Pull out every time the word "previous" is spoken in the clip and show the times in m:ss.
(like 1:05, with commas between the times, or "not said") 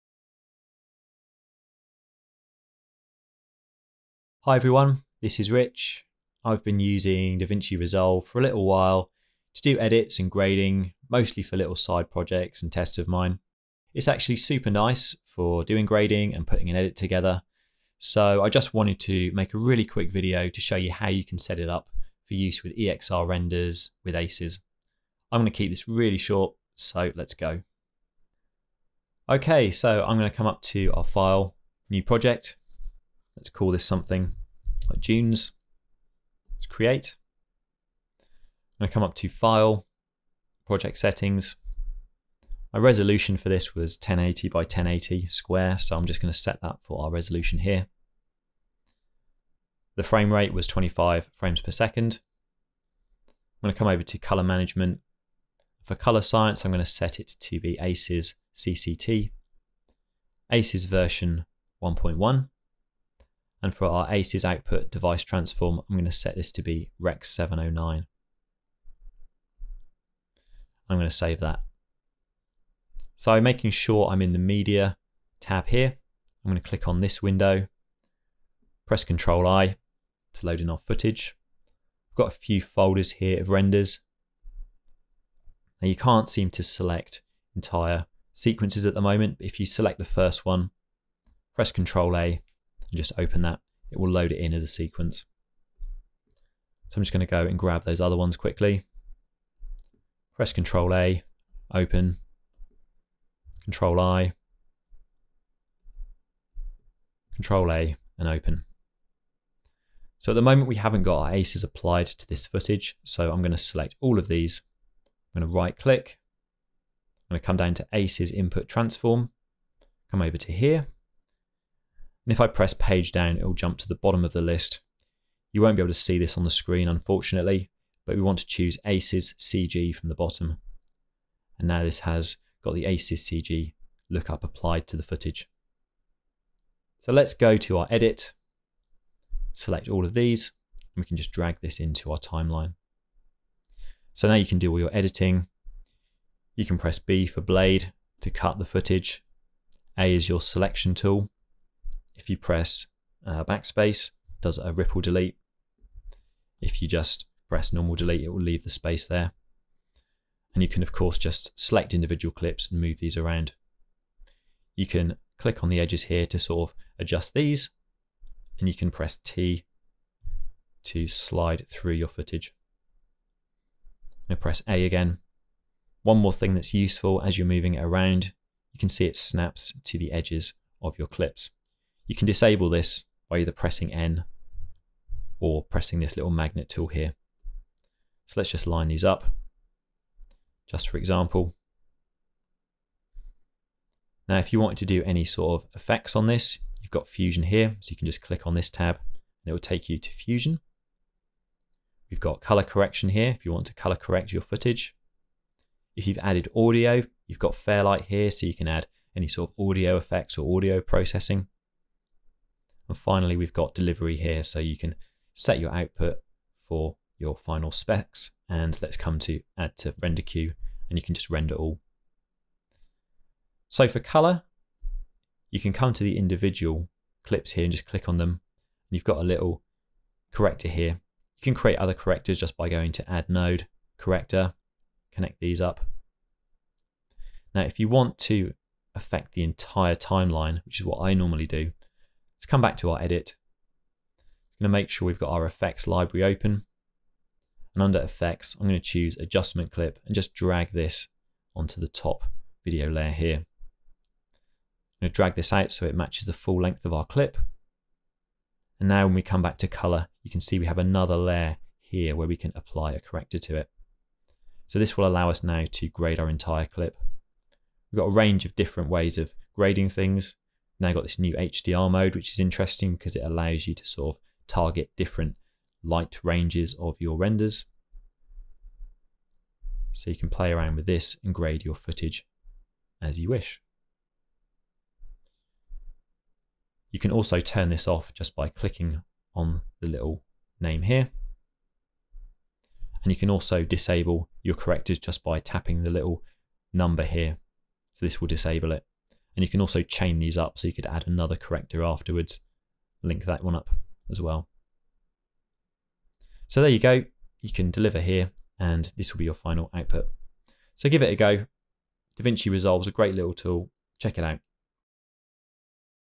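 not said.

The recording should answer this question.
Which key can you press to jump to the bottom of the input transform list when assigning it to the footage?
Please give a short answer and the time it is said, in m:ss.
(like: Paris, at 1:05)
Page Down, at 2:02.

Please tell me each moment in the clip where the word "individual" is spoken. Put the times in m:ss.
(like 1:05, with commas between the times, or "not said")
2:41, 3:46.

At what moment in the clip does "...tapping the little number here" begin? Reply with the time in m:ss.
4:55.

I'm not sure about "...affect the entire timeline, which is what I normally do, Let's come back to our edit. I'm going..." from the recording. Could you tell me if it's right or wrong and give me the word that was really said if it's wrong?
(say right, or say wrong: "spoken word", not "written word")
right.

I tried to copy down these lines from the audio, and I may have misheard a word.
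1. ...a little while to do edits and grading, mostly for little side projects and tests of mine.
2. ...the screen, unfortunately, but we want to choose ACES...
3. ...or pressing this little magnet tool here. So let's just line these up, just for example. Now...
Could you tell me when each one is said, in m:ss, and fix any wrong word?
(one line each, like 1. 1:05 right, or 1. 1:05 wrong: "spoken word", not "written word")
1. 0:08 right
2. 2:06 right
3. 3:05 right.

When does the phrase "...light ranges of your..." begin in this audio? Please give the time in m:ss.
4:35.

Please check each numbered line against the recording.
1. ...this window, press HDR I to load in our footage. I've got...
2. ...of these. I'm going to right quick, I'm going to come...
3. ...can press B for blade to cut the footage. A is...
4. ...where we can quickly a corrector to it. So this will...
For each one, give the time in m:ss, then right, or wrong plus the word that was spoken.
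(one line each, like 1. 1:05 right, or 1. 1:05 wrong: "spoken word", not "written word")
1. 1:17 wrong: "Control", not "HDR"
2. 1:54 wrong: "click", not "quick"
3. 2:26 right
4. 4:22 wrong: "apply", not "quickly".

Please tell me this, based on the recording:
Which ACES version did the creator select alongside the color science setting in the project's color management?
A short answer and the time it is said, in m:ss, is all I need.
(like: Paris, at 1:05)
1.1, at 1:00.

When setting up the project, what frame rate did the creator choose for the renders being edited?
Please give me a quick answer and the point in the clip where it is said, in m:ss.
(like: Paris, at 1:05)
25 frames per second, at 0:50.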